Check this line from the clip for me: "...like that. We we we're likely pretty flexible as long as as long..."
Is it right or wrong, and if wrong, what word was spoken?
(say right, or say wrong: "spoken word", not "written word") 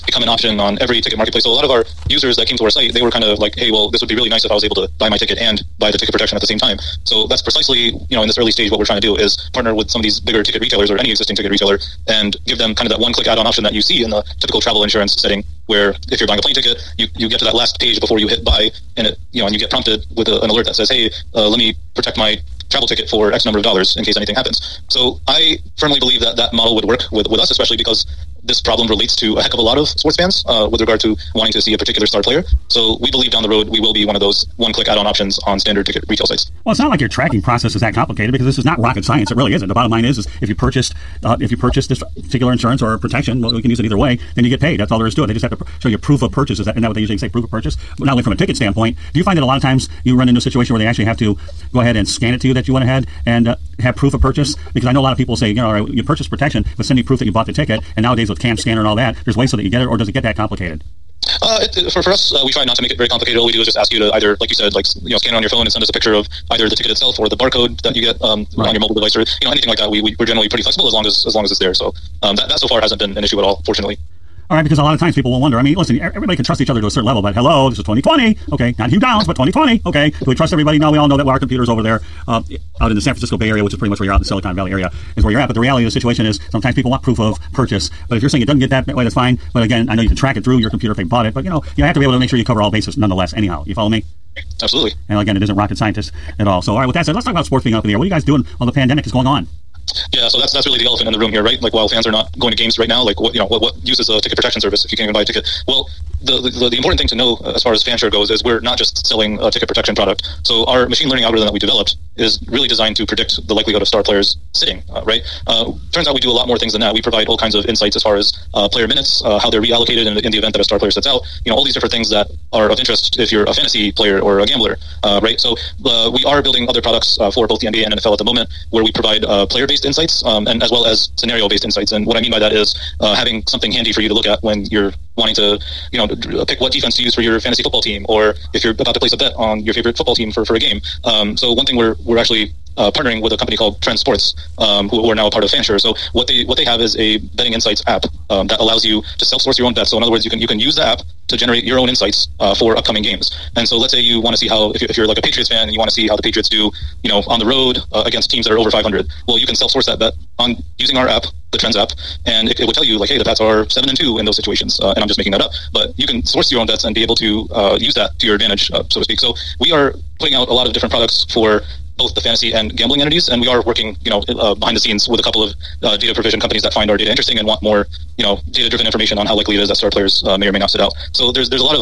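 wrong: "generally", not "likely".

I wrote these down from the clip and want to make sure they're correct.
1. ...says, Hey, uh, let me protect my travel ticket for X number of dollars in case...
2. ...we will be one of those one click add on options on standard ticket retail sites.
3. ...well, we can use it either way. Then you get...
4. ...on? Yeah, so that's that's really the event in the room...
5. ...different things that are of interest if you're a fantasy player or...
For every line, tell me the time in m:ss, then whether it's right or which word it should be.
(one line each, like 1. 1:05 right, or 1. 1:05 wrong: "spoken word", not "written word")
1. 0:20 right
2. 0:33 right
3. 0:43 right
4. 1:39 wrong: "elephant", not "event"
5. 2:01 right.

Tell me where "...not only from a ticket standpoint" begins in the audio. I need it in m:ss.
0:47.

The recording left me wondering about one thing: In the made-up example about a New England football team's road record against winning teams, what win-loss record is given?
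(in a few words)
7 and 2.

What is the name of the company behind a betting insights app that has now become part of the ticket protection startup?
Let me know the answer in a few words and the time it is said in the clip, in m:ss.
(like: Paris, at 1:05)
Trend Sports, at 2:23.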